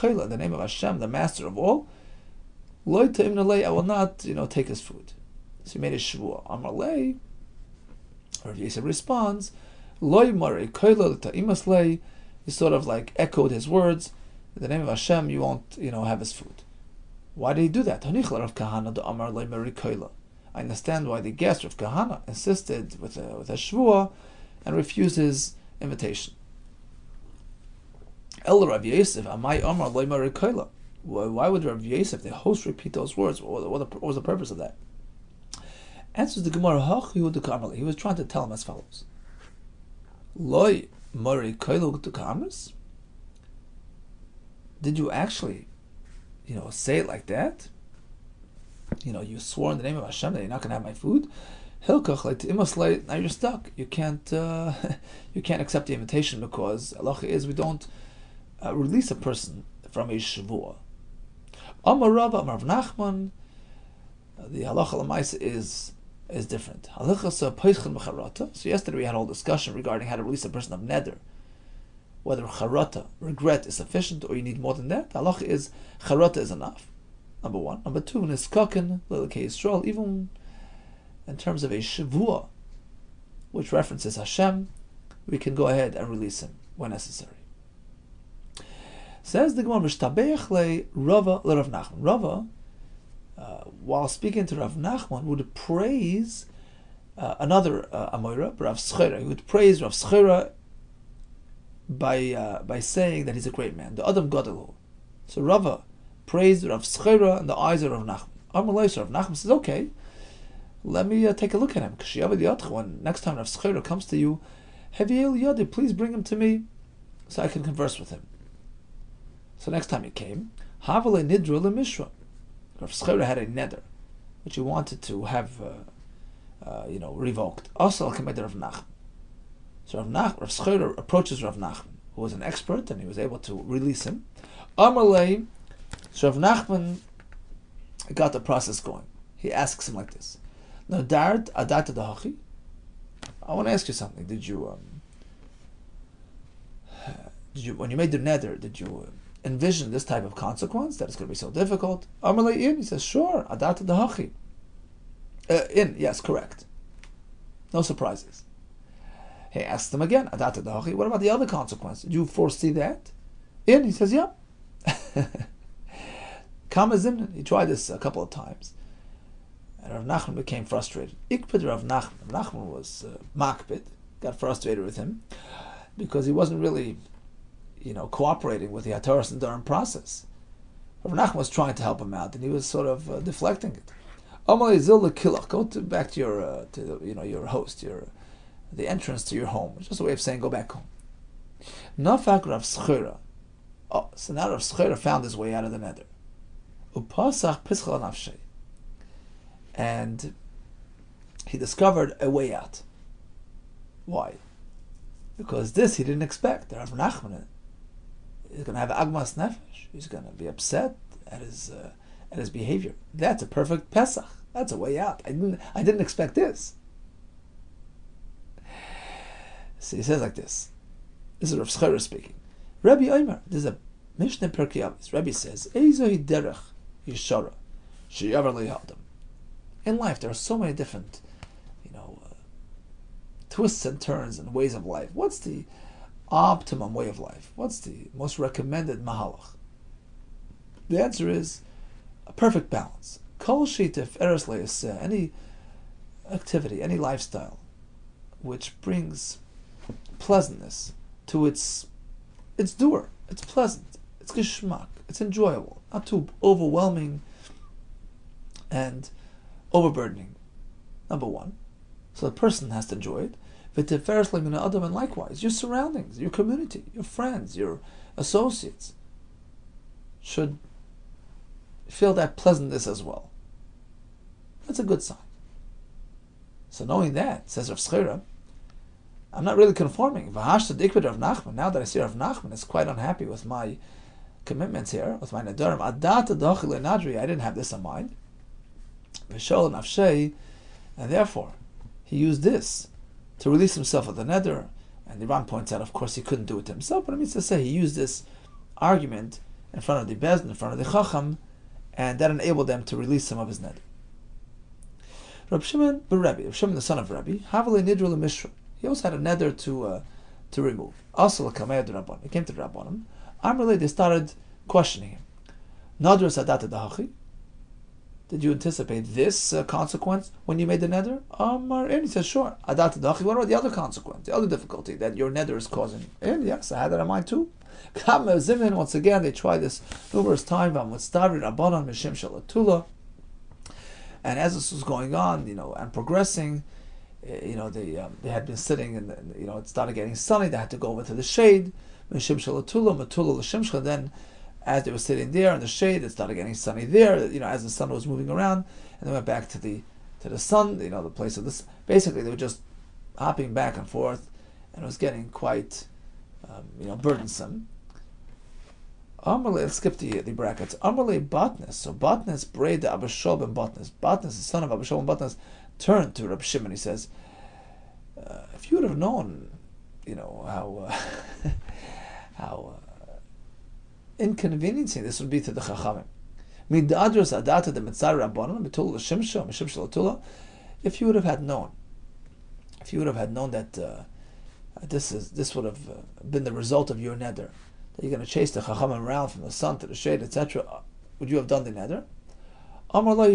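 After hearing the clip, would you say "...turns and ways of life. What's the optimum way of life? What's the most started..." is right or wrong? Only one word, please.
wrong.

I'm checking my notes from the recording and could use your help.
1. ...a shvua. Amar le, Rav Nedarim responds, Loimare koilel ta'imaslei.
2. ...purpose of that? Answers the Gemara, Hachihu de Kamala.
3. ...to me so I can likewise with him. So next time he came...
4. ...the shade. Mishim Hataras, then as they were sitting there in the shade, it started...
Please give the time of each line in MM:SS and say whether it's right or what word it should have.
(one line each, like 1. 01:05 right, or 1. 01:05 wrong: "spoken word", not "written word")
1. 00:05 wrong: "Yisrael", not "Nedarim"
2. 00:34 right
3. 01:56 wrong: "converse", not "likewise"
4. 05:41 wrong: "Shalatula", not "Hataras".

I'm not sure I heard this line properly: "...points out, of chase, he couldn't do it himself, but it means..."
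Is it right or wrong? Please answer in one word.
wrong.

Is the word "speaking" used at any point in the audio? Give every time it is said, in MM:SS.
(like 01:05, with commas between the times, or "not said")
01:34, 03:41.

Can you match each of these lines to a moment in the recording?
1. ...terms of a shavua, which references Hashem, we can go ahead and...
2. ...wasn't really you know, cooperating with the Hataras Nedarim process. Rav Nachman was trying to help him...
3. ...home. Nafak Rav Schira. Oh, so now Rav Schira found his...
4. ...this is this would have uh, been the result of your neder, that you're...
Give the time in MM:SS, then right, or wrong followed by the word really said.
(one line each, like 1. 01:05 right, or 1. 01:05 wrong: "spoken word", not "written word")
1. 01:21 right
2. 02:56 right
3. 03:10 right
4. 06:24 right.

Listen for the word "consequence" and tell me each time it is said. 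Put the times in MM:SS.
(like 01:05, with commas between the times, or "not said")
02:30, 02:41, 05:19, 05:23.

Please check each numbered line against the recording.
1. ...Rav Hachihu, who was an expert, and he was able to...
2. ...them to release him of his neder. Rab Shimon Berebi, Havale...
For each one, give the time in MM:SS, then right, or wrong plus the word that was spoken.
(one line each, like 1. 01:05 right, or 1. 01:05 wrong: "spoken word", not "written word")
1. 02:11 wrong: "Nachman", not "Hachihu"
2. 05:02 wrong: "Rab", not "Havale".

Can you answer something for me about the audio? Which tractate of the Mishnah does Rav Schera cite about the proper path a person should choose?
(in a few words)
Perkei Avos.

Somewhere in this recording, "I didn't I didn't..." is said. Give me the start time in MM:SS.
03:35.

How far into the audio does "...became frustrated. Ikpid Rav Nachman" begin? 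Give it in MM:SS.
02:50.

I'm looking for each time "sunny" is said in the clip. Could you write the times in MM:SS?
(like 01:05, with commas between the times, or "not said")
05:40, 05:46.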